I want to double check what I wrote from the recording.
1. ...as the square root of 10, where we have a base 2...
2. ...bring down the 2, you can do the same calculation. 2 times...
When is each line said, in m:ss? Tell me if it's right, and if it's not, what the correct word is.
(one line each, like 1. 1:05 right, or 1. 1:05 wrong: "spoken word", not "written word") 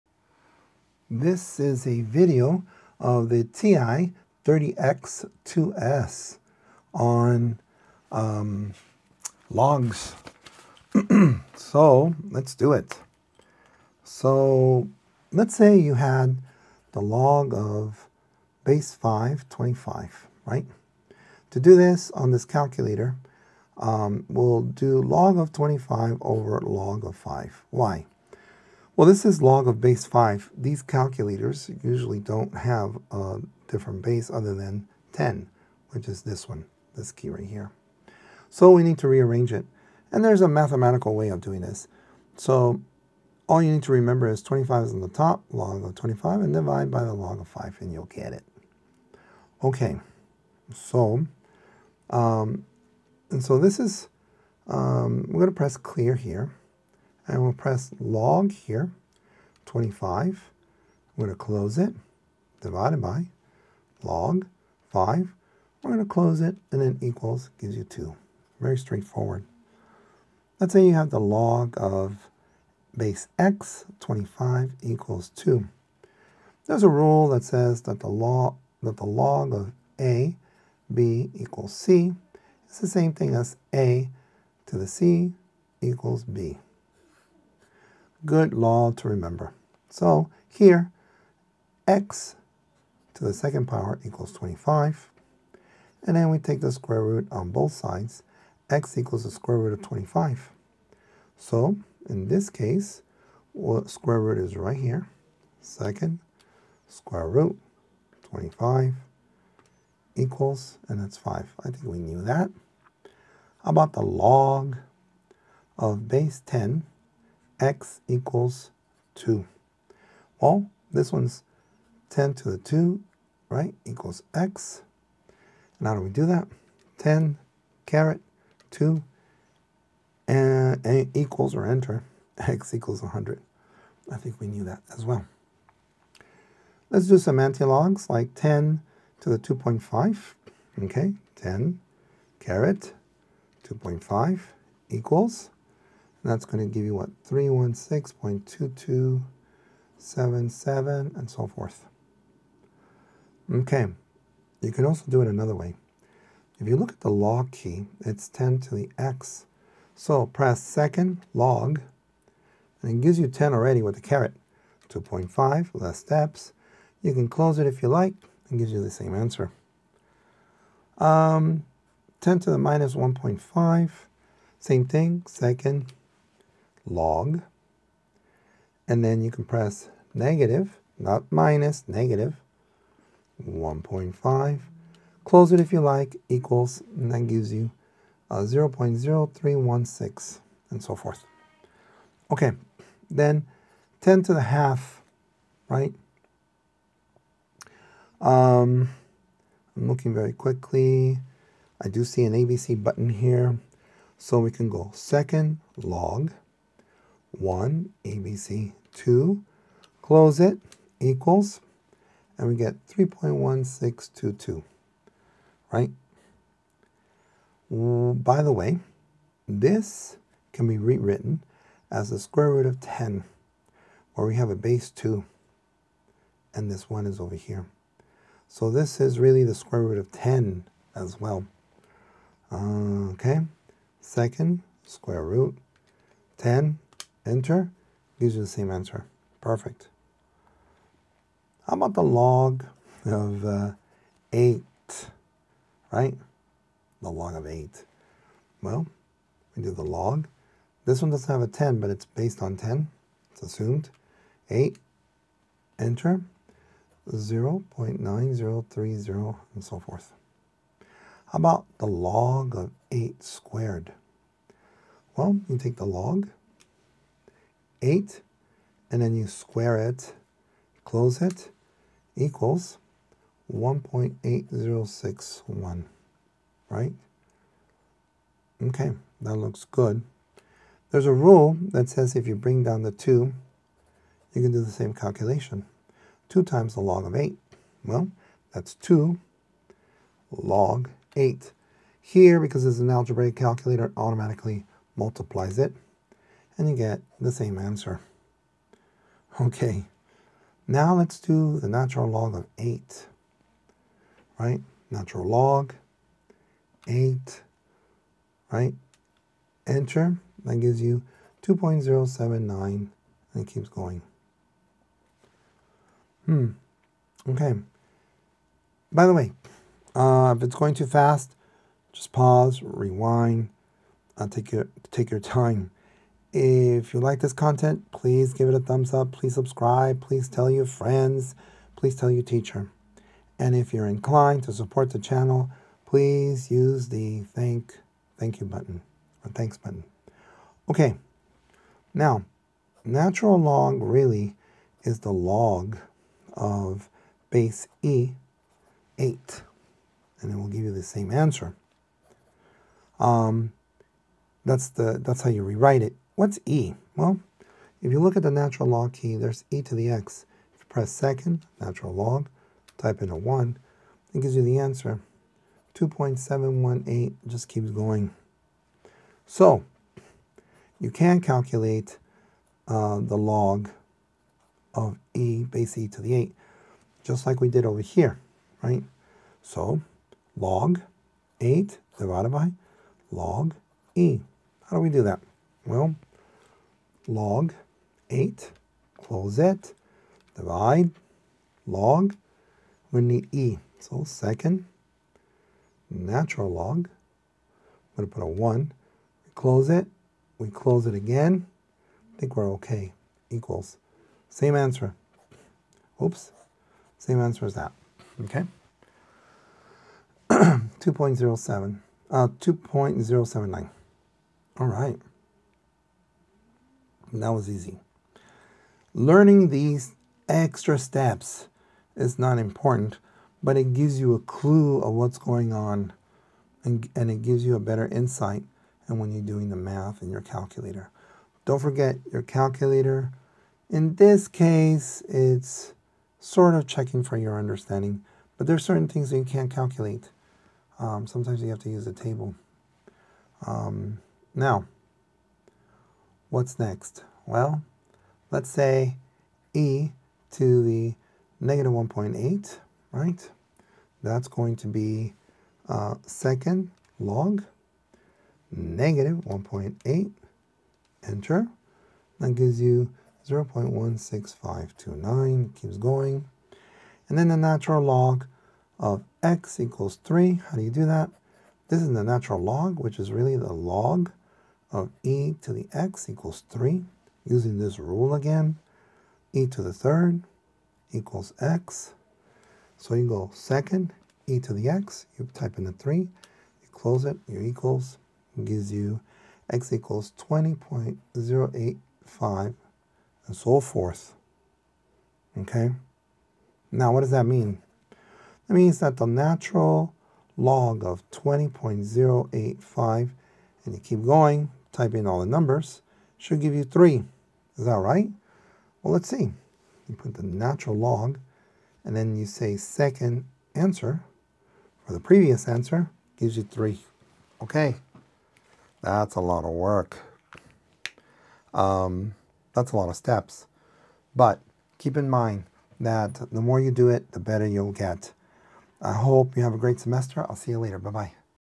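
1. 3:41 right
2. 4:42 right.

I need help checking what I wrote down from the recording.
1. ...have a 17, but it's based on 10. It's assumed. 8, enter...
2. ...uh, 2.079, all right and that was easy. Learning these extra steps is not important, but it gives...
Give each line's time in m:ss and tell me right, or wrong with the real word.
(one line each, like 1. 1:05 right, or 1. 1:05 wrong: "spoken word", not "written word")
1. 4:11 wrong: "10", not "17"
2. 6:52 right.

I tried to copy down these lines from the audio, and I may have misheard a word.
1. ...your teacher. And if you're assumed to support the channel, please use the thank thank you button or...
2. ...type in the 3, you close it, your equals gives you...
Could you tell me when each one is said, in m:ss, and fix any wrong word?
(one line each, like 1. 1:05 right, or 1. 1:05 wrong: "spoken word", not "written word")
1. 5:32 wrong: "inclined", not "assumed"
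2. 8:05 right.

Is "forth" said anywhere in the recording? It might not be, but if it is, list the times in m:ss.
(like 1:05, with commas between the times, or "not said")
2:31, 3:10, 4:19, 8:13.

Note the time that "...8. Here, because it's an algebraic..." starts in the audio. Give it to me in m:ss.
4:51.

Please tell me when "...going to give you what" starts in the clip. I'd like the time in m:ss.
2:26.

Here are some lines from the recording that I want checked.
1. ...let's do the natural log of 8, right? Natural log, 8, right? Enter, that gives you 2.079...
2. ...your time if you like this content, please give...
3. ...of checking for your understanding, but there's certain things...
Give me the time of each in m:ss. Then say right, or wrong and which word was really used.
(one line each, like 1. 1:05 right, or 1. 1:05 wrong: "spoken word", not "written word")
1. 5:00 right
2. 5:25 right
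3. 7:16 right.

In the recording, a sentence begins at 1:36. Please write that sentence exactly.
And then we take the square root on both sides.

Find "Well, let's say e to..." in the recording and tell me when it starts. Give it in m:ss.
7:27.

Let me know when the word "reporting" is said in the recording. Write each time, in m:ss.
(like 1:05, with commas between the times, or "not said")
not said.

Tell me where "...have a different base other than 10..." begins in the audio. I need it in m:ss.
0:32.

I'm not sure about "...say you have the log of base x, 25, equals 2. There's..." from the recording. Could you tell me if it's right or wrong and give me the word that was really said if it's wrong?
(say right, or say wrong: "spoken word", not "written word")
right.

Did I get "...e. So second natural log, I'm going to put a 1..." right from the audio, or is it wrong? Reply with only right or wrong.
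right.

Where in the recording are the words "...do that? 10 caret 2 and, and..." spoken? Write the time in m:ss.
2:06.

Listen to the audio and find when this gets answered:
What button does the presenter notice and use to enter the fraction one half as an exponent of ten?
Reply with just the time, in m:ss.
3:22.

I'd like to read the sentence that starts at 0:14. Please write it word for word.
So let's say you had the log of base 5, 25, right?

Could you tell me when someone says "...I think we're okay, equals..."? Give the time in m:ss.
6:42.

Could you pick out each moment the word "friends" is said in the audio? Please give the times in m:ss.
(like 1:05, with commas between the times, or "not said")
5:30.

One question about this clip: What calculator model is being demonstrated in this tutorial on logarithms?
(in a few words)
TI 30X2S.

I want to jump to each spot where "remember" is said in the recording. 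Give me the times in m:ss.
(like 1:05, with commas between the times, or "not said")
0:43, 1:29.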